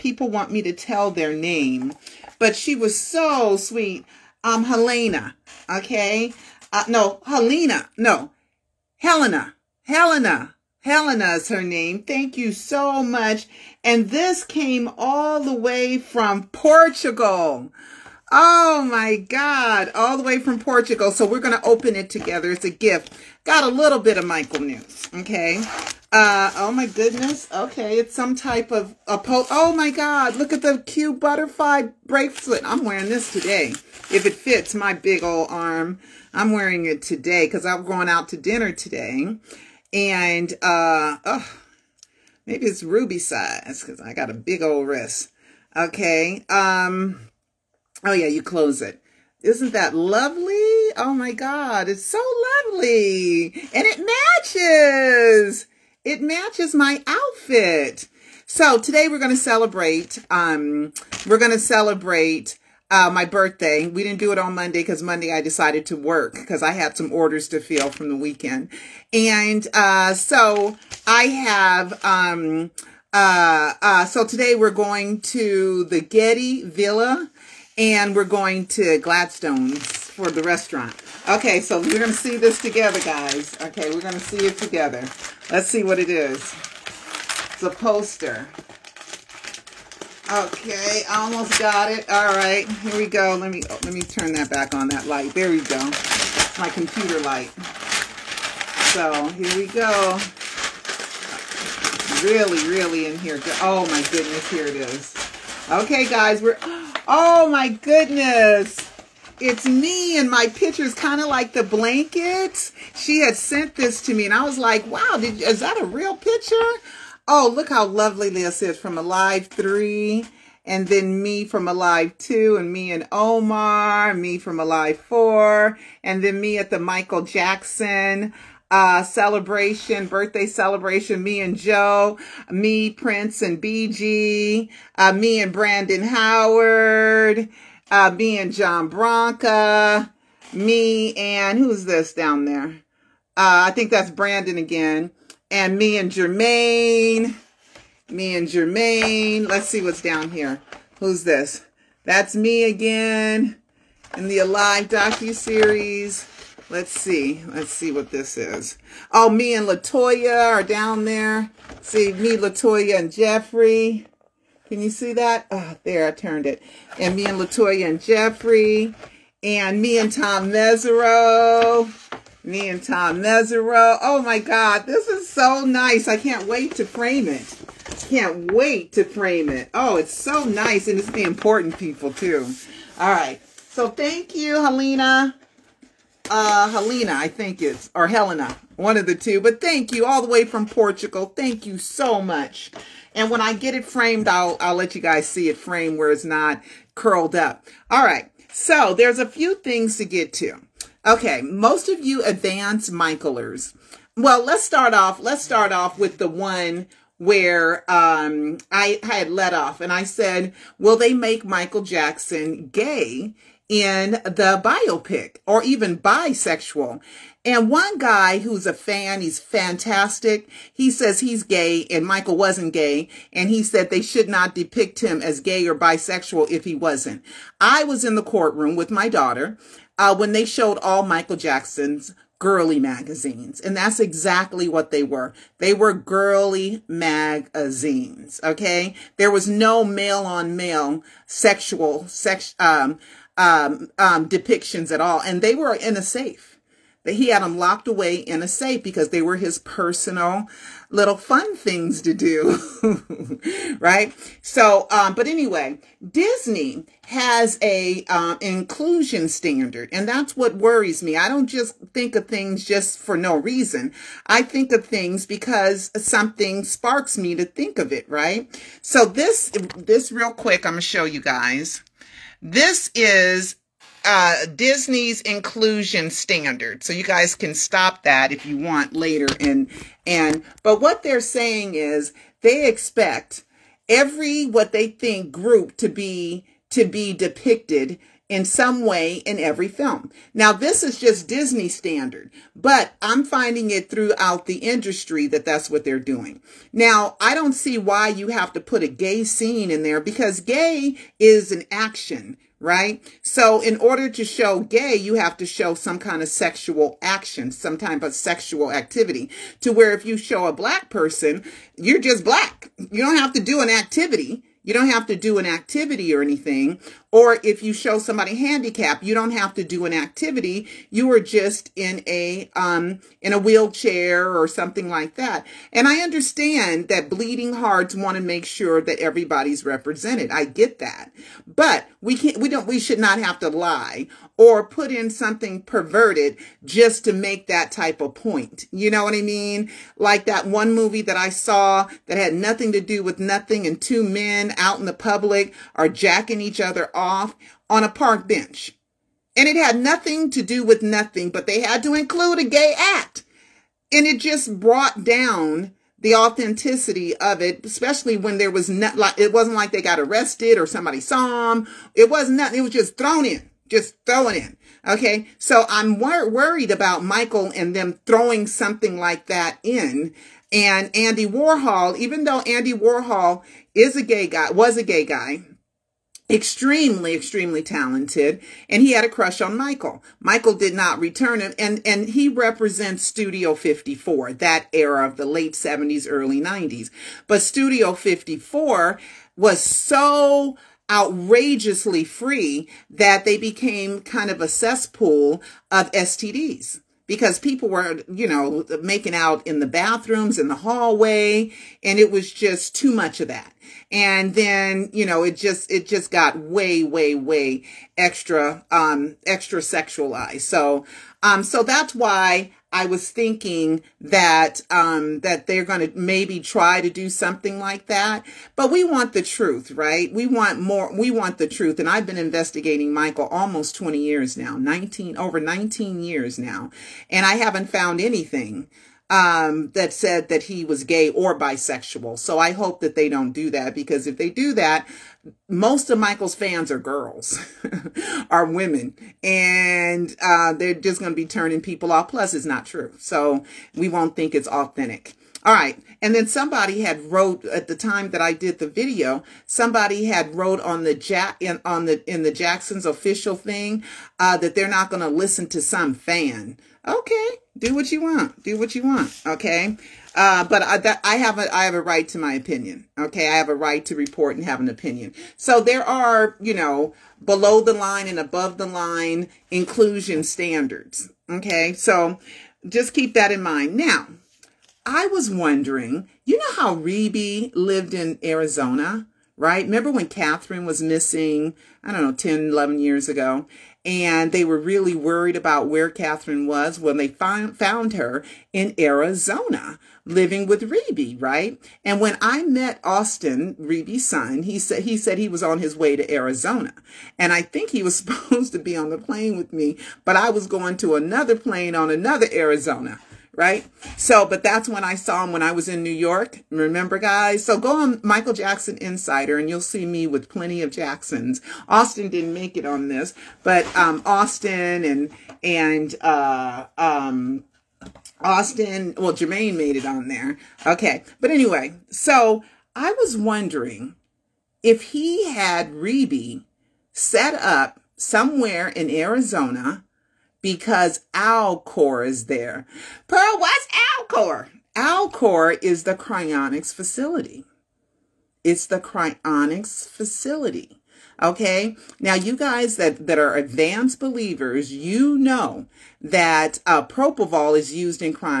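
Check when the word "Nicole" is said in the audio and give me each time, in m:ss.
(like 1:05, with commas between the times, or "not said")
not said.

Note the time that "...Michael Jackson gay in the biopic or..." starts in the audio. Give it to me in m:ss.
3:31.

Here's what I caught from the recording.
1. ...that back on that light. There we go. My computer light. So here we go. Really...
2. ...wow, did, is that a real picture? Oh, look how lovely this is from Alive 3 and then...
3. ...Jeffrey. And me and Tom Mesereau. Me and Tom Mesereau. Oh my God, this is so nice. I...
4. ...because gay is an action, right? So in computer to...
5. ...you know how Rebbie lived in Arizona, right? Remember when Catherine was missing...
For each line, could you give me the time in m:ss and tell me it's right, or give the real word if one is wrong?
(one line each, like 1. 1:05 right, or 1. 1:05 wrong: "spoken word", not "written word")
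1. 1:34 right
2. 1:54 right
3. 2:48 right
4. 4:59 wrong: "order", not "computer"
5. 7:56 right.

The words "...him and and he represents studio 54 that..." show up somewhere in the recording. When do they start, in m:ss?
6:21.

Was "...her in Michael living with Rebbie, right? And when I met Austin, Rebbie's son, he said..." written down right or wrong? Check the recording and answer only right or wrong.
wrong.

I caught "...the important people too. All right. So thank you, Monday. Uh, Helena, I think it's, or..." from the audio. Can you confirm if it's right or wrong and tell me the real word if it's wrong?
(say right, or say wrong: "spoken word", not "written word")
wrong: "Helena", not "Monday".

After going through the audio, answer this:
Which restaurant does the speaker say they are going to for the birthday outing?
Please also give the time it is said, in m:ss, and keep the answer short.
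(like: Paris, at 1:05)
Gladstone's, at 1:18.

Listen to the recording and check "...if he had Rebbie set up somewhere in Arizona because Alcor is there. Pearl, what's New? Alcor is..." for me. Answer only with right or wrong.
wrong.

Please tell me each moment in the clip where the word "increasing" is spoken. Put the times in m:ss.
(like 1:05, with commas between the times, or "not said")
not said.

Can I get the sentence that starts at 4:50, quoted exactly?
Now, this is just Disney standard, but I'm finding it throughout the industry that that's what they're doing.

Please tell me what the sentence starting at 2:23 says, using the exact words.
Uh, I think that's Brandon again.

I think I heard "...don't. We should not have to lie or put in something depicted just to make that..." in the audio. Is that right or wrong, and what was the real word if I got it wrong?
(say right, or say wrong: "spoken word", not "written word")
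wrong: "perverted", not "depicted".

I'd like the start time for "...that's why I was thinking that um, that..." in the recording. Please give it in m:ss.
6:51.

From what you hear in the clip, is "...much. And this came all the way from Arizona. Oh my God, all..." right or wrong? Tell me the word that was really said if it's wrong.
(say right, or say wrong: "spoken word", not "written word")
wrong: "Portugal", not "Arizona".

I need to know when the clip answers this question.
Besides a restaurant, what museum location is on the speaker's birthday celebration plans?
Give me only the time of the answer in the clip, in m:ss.
1:16.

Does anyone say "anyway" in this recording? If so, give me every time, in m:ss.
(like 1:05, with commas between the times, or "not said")
4:15, 8:41.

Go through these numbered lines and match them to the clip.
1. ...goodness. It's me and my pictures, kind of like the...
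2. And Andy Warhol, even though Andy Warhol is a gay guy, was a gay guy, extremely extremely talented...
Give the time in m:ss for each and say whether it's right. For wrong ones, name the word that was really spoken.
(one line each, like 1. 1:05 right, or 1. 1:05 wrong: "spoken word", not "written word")
1. 1:47 right
2. 6:10 right.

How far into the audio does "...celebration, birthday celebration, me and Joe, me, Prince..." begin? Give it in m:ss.
2:09.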